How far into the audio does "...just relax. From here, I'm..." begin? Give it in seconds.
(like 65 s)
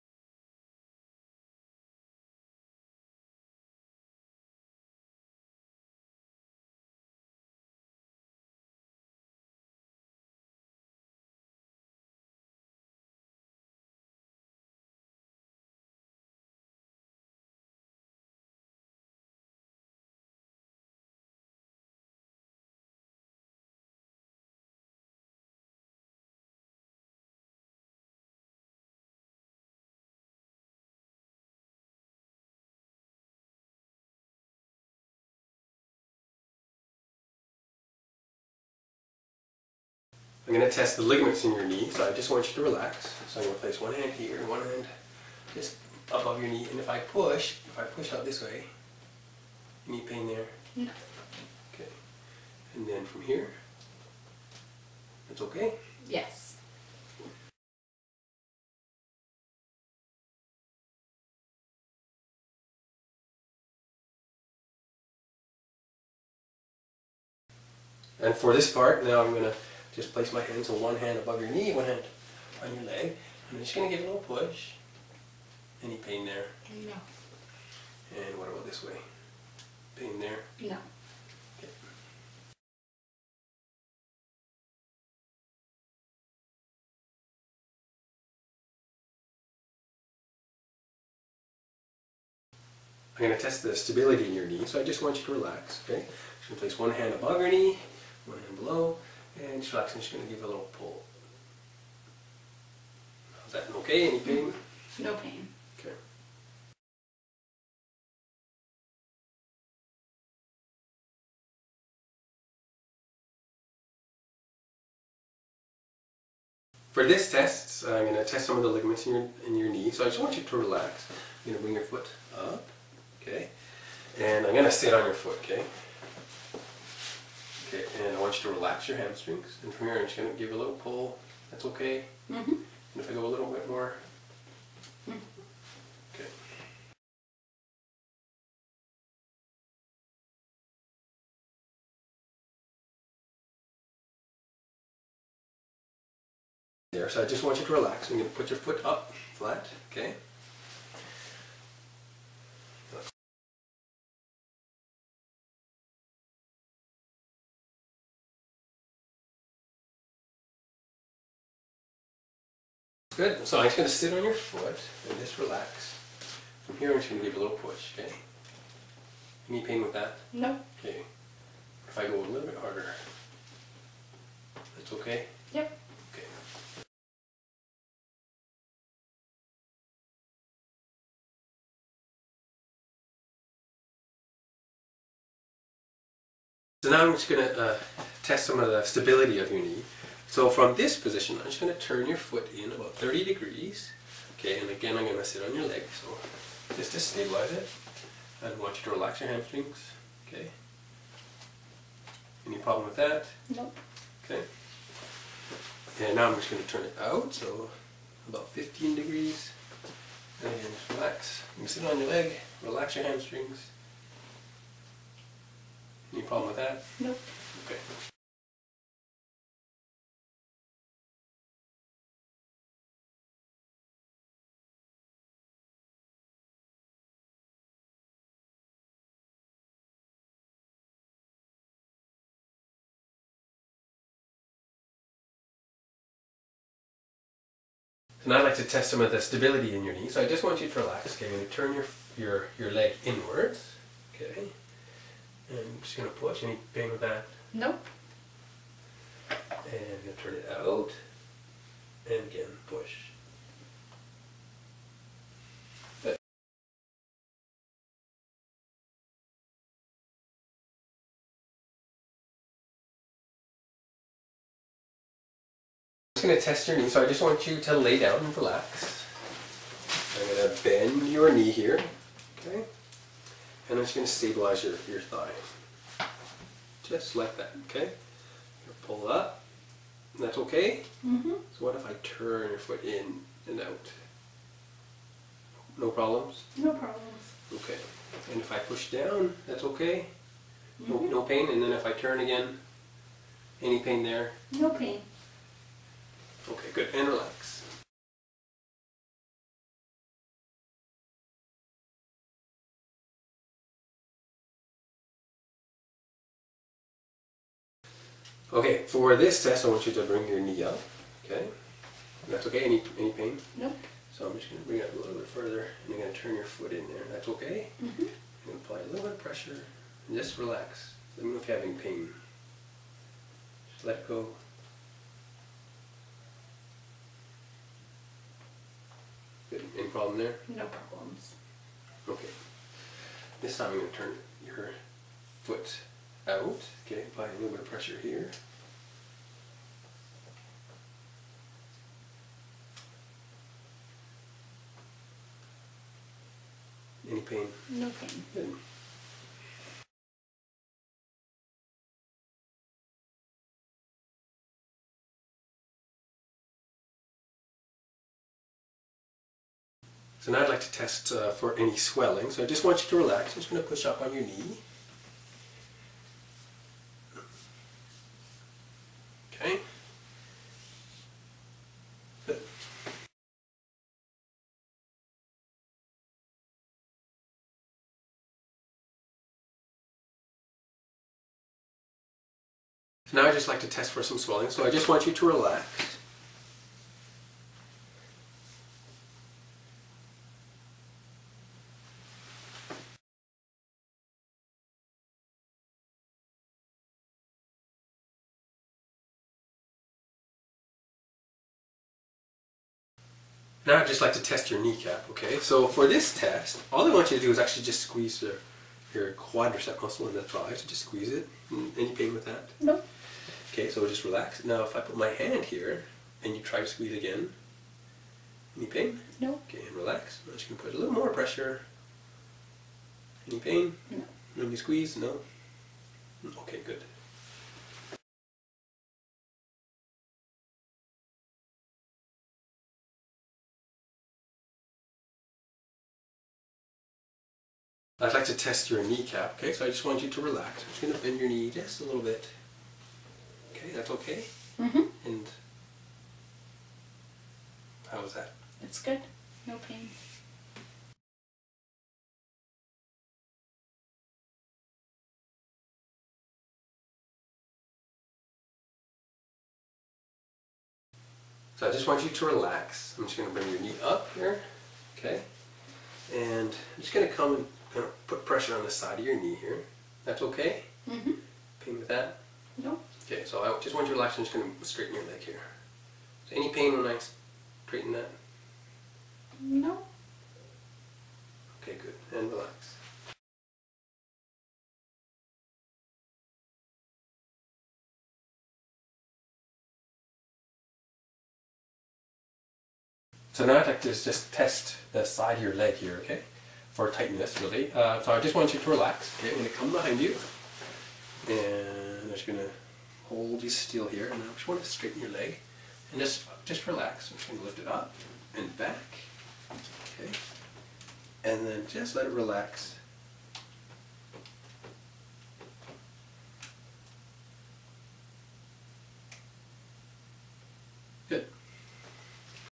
165 s.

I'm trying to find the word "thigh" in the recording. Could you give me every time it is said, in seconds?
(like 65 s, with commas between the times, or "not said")
275 s, 410 s.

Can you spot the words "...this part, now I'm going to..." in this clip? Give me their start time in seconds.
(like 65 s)
68 s.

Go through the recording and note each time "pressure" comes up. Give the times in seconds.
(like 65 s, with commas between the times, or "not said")
319 s, 337 s, 421 s, 468 s.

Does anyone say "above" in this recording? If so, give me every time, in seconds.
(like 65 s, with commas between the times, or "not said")
46 s, 71 s, 97 s.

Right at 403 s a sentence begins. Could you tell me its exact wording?
Now I'd just like to test your kneecap, okay?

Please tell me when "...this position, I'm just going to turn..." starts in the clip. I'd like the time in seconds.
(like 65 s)
190 s.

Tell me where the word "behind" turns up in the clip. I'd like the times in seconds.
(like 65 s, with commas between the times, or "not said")
499 s.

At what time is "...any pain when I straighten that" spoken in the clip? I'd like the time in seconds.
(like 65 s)
476 s.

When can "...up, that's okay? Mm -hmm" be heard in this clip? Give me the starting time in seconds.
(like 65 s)
279 s.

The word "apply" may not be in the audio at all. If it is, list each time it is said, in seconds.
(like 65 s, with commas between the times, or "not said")
318 s, 337 s.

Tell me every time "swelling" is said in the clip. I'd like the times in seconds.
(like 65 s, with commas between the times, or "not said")
361 s, 384 s.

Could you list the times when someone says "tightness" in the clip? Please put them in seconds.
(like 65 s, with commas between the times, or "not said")
496 s.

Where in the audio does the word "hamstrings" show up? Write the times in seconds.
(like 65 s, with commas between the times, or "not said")
128 s, 199 s, 213 s.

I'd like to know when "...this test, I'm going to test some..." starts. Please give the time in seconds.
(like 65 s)
117 s.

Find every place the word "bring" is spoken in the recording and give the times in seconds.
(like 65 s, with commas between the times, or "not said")
121 s, 310 s, 314 s, 463 s.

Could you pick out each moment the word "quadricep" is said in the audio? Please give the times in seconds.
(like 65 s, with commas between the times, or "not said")
409 s.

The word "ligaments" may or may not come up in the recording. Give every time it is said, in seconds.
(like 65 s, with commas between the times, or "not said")
41 s, 118 s.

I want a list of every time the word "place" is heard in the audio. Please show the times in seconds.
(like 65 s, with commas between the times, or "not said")
43 s, 70 s, 96 s.